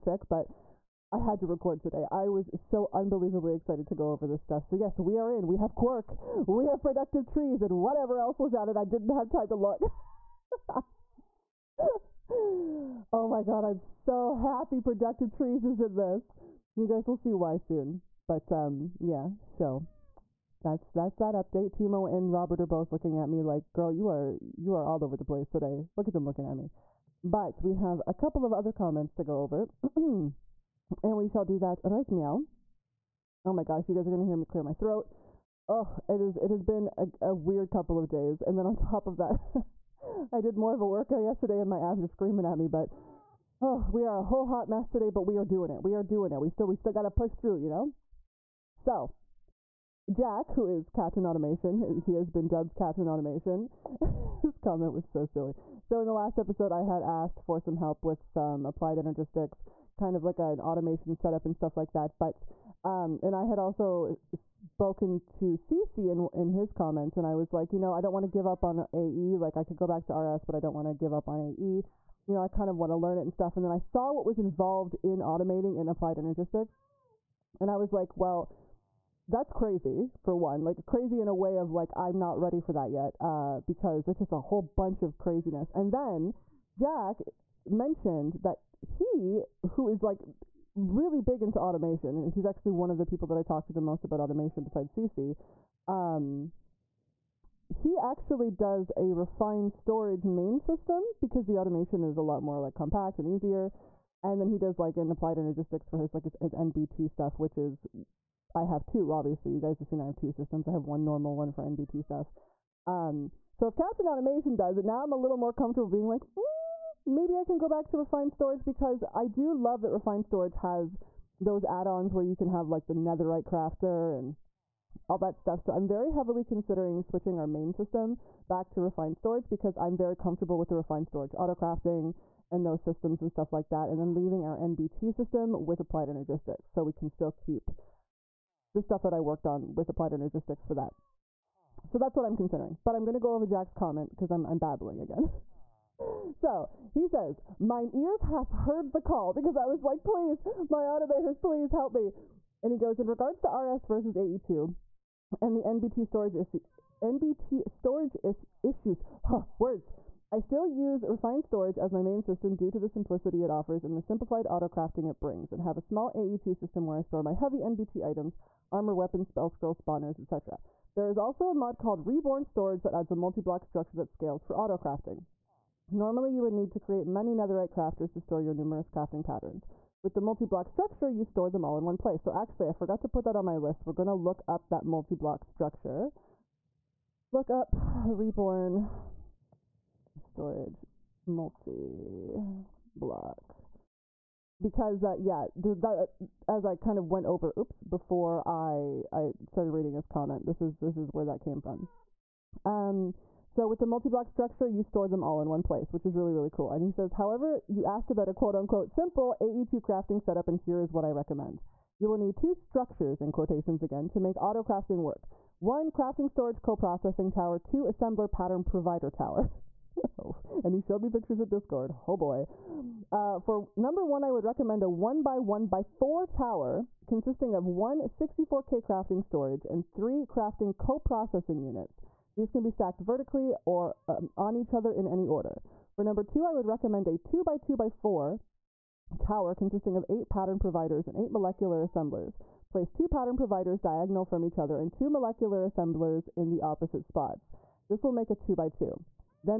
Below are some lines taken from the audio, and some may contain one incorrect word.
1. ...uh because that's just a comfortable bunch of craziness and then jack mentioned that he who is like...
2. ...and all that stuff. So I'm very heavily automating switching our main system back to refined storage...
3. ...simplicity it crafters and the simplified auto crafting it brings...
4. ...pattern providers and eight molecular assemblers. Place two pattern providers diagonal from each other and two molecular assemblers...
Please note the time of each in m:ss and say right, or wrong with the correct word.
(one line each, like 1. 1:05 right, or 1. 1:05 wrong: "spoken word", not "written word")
1. 1:23 wrong: "whole", not "comfortable"
2. 2:04 wrong: "considering", not "automating"
3. 2:42 wrong: "offers", not "crafters"
4. 4:00 right.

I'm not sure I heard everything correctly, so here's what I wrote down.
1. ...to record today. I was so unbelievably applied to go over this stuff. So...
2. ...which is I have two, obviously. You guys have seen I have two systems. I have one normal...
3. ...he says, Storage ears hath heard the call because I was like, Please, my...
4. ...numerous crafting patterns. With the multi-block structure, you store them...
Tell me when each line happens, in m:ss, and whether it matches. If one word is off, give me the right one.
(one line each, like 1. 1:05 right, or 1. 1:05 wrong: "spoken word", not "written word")
1. 0:01 wrong: "excited", not "applied"
2. 1:47 right
3. 2:26 wrong: "Mine", not "Storage"
4. 2:58 right.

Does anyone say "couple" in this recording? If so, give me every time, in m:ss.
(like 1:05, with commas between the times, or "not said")
0:28, 0:37.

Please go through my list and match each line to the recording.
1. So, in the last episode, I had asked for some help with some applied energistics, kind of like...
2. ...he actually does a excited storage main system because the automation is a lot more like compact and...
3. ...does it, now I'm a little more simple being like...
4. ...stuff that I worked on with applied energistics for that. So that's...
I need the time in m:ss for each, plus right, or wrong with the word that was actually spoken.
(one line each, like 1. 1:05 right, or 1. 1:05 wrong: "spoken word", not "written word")
1. 0:55 right
2. 1:37 wrong: "refined", not "excited"
3. 1:54 wrong: "comfortable", not "simple"
4. 2:18 right.